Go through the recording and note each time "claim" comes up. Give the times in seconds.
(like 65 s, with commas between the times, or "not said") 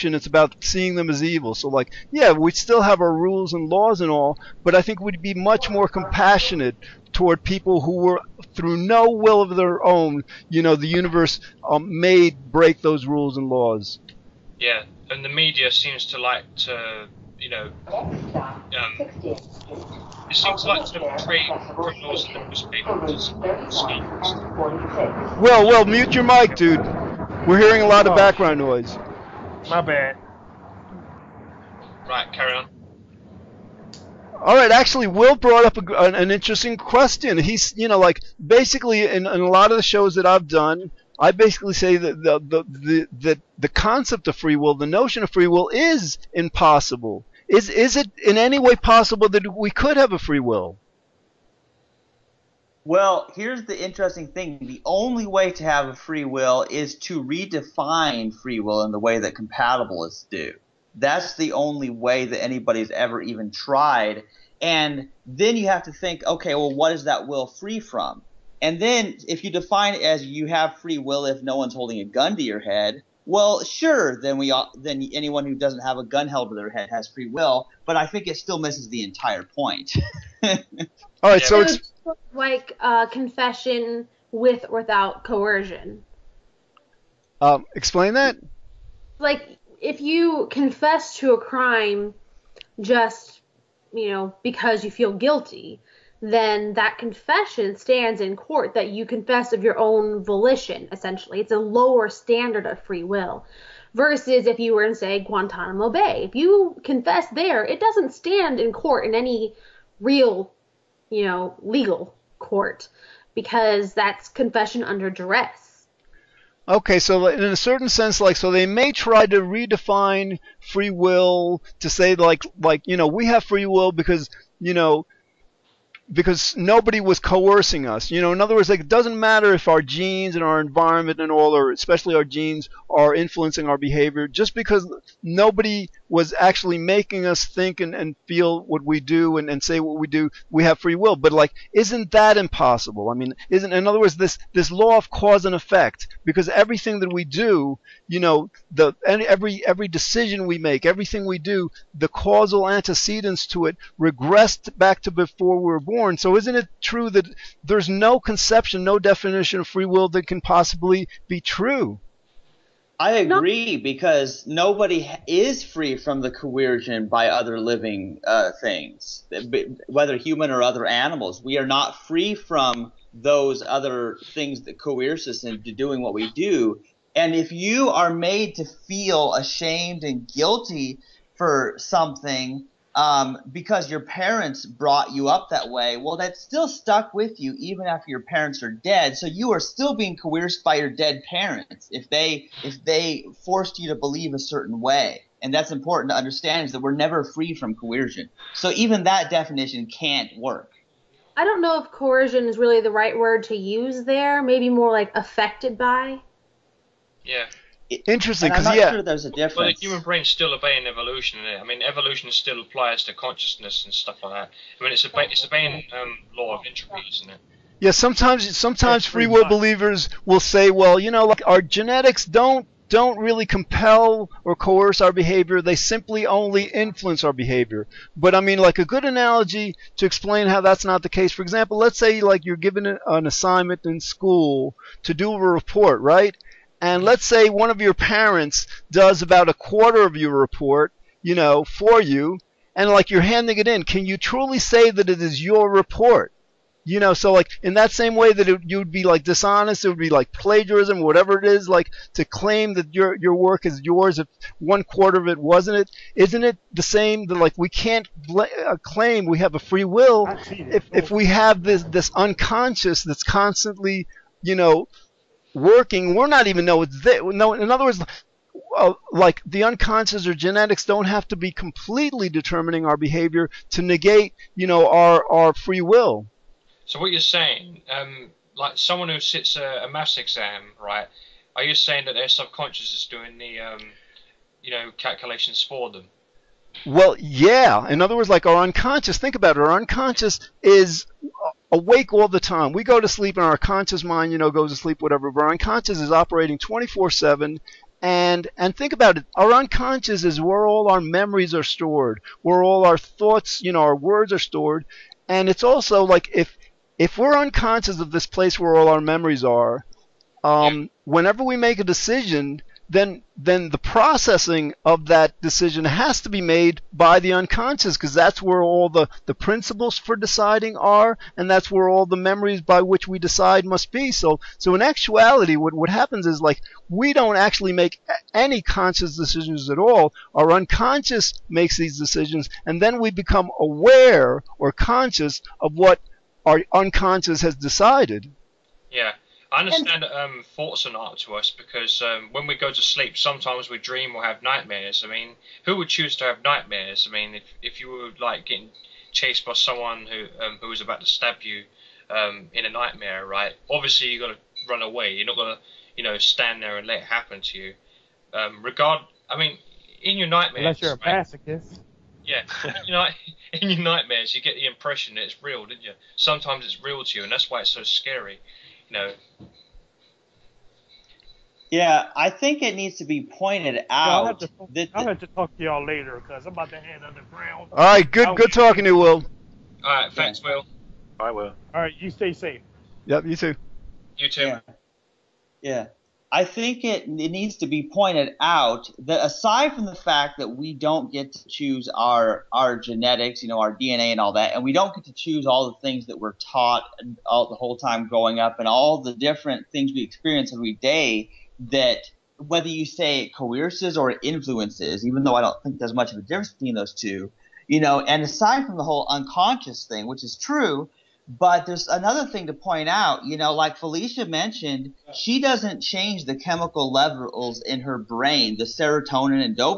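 252 s, 258 s.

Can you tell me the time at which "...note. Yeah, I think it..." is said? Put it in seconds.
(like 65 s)
368 s.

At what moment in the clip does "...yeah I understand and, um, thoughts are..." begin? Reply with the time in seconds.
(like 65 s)
338 s.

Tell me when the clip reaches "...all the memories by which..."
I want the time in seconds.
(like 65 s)
321 s.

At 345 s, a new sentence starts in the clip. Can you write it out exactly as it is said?
I mean, who would choose to have nightmares?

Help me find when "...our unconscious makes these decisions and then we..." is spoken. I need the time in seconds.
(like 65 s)
330 s.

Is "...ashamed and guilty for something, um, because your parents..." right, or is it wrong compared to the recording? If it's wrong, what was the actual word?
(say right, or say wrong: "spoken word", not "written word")
right.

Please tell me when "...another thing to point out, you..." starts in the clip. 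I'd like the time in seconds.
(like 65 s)
411 s.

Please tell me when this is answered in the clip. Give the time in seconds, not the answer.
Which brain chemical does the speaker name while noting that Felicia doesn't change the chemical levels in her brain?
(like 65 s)
418 s.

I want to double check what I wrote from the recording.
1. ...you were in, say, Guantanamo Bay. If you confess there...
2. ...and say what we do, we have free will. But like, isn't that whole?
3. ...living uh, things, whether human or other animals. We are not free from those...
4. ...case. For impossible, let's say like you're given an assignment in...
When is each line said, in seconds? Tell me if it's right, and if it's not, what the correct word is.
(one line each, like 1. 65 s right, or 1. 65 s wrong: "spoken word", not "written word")
1. 104 s right
2. 139 s wrong: "impossible", not "whole"
3. 167 s right
4. 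231 s wrong: "example", not "impossible".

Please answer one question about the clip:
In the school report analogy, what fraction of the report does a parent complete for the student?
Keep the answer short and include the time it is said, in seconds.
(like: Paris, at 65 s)
a quarter, at 239 s.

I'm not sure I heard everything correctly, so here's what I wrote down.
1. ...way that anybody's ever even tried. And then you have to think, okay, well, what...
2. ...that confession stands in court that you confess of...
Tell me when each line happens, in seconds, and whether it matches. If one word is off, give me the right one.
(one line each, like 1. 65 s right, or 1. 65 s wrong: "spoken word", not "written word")
1. 61 s right
2. 96 s right.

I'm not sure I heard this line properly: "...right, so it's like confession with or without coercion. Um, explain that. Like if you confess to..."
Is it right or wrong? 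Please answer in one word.
right.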